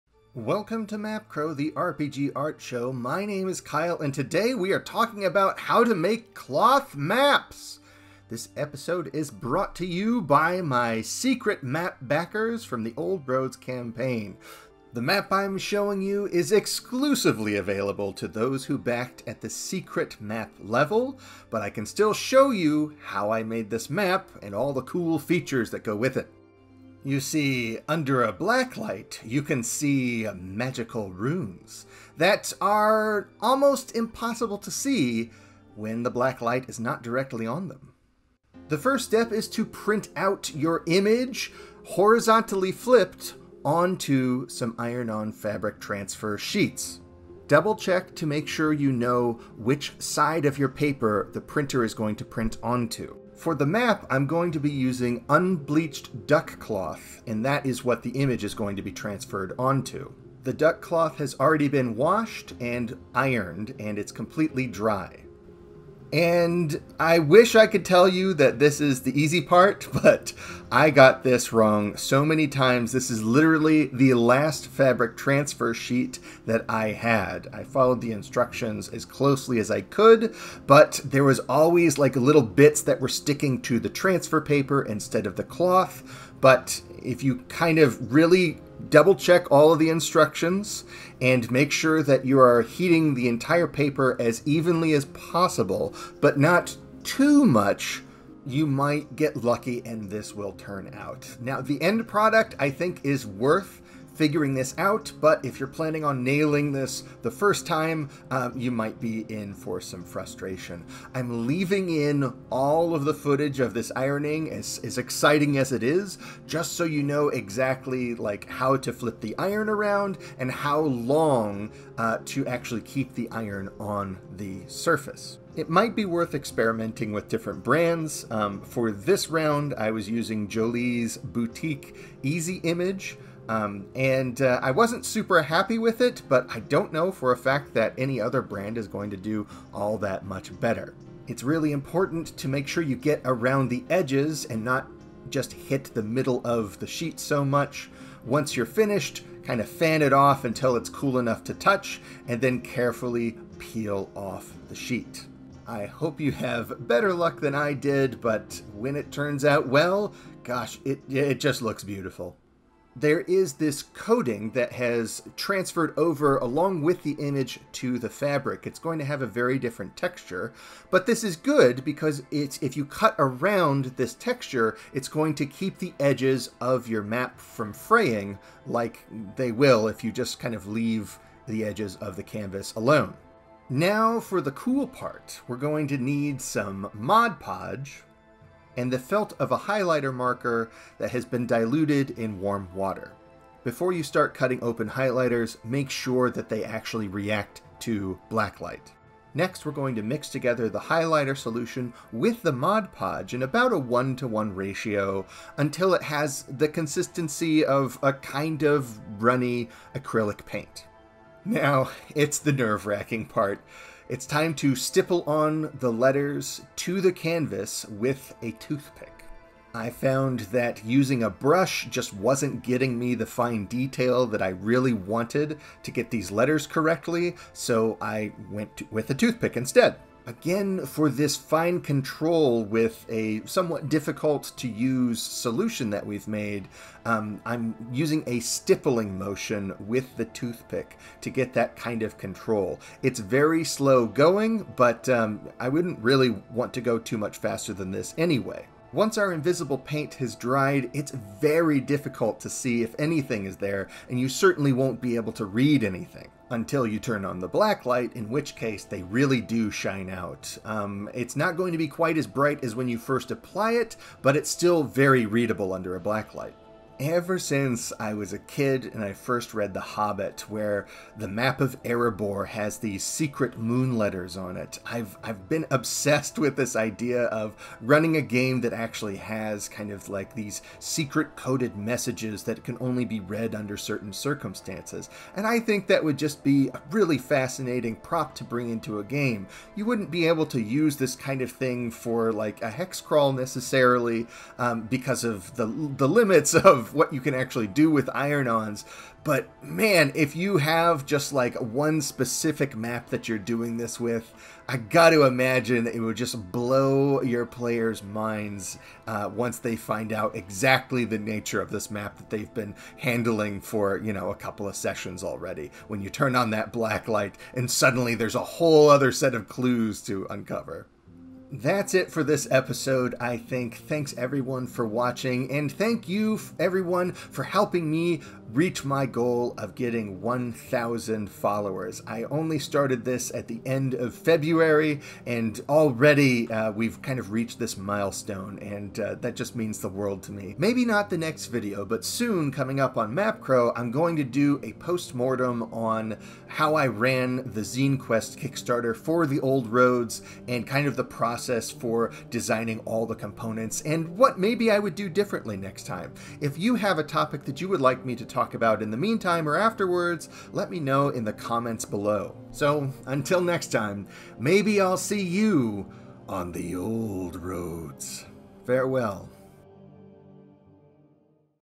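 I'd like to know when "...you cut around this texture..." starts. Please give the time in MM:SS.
02:52.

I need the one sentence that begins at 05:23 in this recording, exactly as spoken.
Thanks everyone for watching, and thank you everyone for helping me reach my goal of getting 1,000 followers.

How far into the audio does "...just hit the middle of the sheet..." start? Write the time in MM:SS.
02:25.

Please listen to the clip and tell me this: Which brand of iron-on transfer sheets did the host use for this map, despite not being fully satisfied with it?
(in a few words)
Jolee's Boutique Easy Image.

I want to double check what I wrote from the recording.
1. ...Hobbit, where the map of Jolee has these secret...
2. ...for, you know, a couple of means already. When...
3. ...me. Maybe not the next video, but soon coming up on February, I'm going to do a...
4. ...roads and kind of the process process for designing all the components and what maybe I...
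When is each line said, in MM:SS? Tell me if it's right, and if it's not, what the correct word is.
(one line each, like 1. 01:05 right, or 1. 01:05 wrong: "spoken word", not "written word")
1. 04:29 wrong: "Erebor", not "Jolee"
2. 05:13 wrong: "sessions", not "means"
3. 05:40 wrong: "MapCrow", not "February"
4. 05:49 right.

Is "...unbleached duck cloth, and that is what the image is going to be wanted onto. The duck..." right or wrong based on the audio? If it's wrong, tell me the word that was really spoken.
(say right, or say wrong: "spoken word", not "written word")
wrong: "transferred", not "wanted".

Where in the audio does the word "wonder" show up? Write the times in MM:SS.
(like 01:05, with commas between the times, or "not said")
not said.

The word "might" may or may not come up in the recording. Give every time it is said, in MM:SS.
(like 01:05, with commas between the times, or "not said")
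01:38, 01:48, 02:05.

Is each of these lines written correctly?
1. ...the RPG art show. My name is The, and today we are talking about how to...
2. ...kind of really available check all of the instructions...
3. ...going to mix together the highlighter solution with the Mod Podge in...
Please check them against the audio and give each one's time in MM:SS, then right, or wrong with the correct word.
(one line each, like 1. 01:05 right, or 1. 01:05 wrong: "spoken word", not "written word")
1. 00:01 wrong: "Kyle", not "The"
2. 01:27 wrong: "double", not "available"
3. 03:19 right.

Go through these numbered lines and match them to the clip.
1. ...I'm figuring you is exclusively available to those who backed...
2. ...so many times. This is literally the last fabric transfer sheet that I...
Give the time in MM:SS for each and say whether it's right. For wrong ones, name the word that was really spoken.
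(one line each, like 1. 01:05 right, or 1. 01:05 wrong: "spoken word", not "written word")
1. 00:15 wrong: "showing", not "figuring"
2. 01:11 right.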